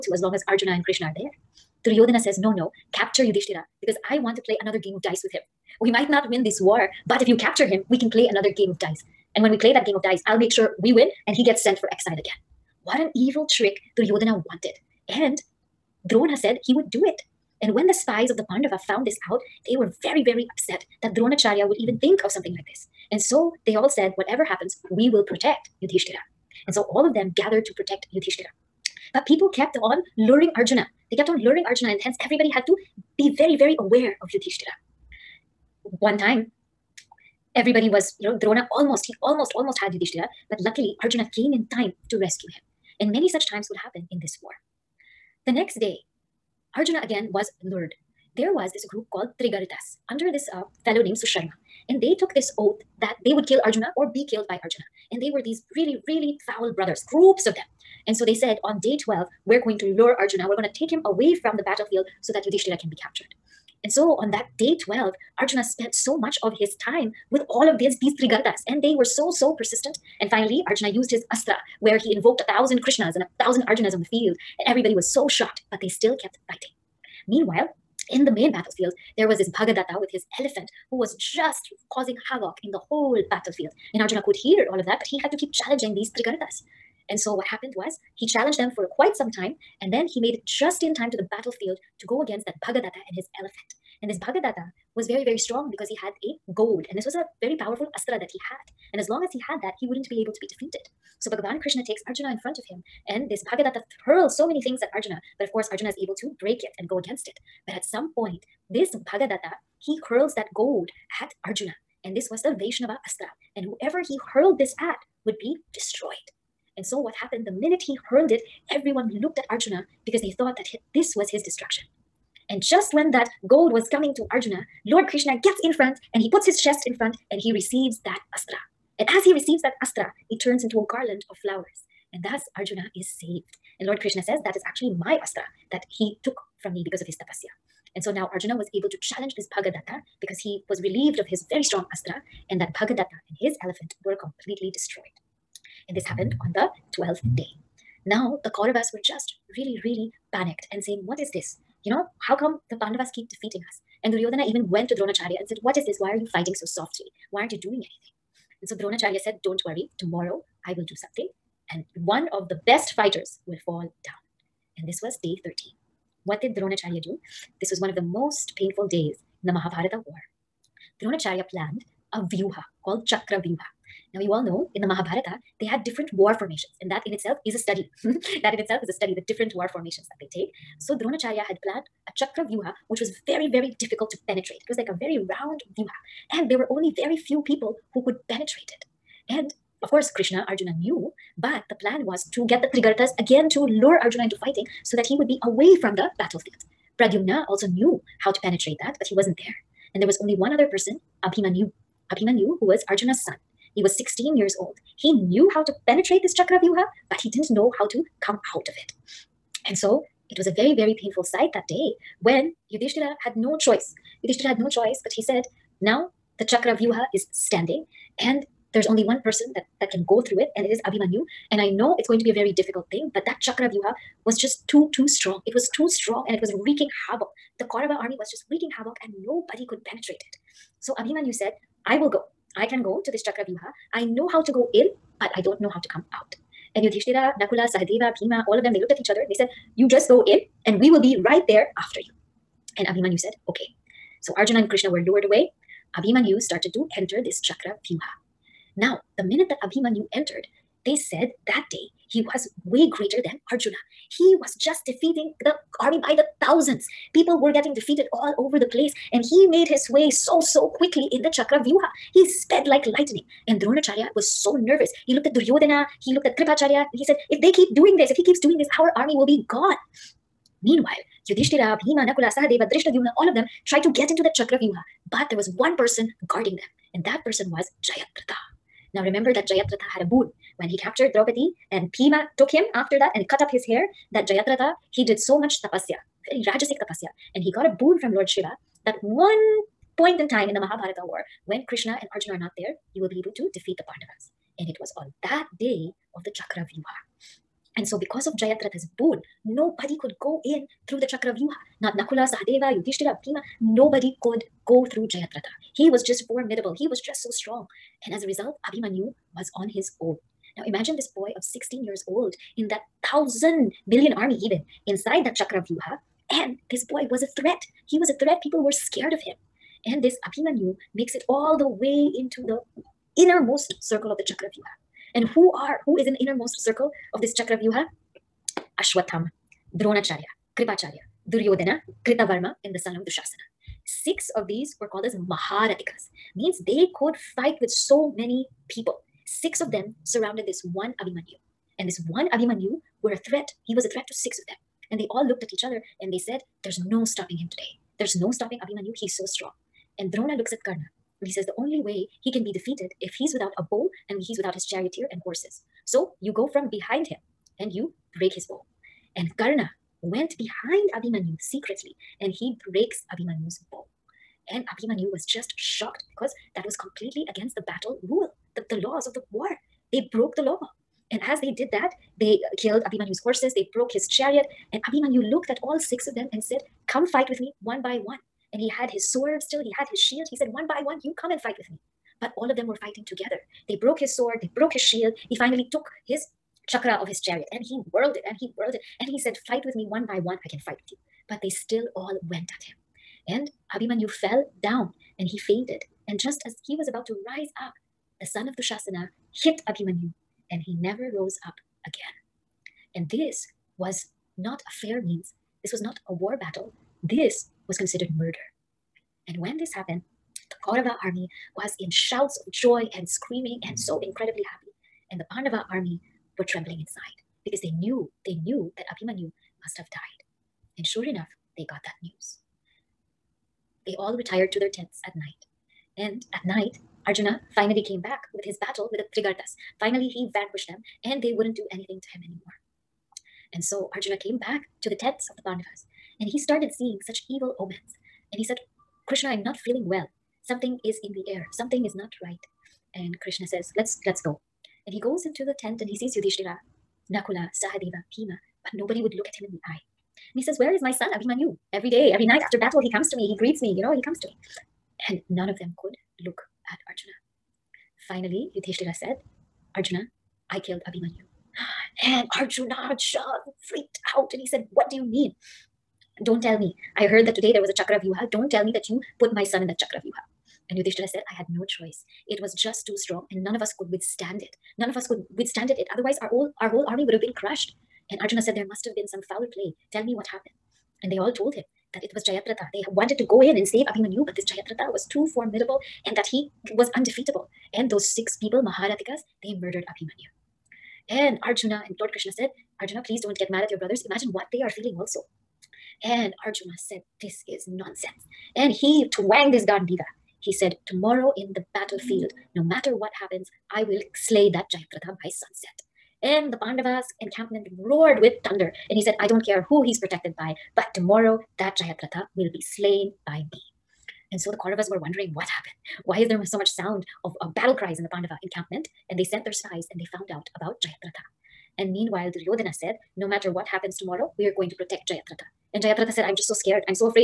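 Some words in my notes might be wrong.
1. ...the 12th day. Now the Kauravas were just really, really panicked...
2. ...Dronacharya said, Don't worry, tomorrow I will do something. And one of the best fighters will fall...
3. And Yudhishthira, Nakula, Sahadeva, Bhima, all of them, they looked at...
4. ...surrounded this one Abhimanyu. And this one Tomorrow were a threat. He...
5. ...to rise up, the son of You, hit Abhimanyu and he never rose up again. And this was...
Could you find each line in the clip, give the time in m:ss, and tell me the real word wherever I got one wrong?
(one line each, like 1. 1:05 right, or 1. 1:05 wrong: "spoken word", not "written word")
1. 2:26 right
2. 2:38 right
3. 3:56 right
4. 5:40 wrong: "Abhimanyu", not "Tomorrow"
5. 6:37 wrong: "Dushasana", not "You".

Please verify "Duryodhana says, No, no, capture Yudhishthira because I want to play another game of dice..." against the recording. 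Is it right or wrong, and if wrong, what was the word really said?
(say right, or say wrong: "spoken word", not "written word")
right.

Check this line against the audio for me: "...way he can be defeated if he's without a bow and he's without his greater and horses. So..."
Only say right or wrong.
wrong.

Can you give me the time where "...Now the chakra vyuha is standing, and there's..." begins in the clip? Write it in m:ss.
3:35.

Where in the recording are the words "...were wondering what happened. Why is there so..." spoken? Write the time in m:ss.
8:34.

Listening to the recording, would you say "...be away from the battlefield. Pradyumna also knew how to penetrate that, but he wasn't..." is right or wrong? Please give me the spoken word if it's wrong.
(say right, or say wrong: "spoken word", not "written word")
right.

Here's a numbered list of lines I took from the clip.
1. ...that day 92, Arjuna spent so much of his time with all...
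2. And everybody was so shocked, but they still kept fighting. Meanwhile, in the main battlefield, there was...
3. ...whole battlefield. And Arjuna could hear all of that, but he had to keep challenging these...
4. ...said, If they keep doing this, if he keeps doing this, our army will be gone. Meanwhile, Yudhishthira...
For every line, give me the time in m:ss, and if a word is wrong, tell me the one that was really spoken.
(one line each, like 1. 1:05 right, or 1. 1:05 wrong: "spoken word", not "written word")
1. 1:04 wrong: "12", not "92"
2. 1:14 right
3. 1:22 right
4. 4:27 right.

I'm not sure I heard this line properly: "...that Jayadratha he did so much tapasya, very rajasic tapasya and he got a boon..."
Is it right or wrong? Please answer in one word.
right.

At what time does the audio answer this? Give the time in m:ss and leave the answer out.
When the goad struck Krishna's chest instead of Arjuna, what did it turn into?
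2:10.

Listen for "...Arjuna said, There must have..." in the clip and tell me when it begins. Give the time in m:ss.
7:58.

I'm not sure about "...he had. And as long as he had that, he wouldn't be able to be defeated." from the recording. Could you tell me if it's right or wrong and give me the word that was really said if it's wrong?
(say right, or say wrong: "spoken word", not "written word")
right.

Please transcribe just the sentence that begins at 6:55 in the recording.
And the Pandava army were trembling inside because they knew, they knew that Abhimanyu must have died.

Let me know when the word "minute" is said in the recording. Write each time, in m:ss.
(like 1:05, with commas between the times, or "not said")
1:57, 4:09.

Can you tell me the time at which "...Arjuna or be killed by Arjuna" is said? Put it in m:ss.
0:53.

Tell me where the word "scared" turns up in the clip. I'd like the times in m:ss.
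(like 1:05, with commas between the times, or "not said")
5:18, 8:46.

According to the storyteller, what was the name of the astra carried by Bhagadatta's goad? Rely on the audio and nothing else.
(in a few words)
Vaishnava Astra.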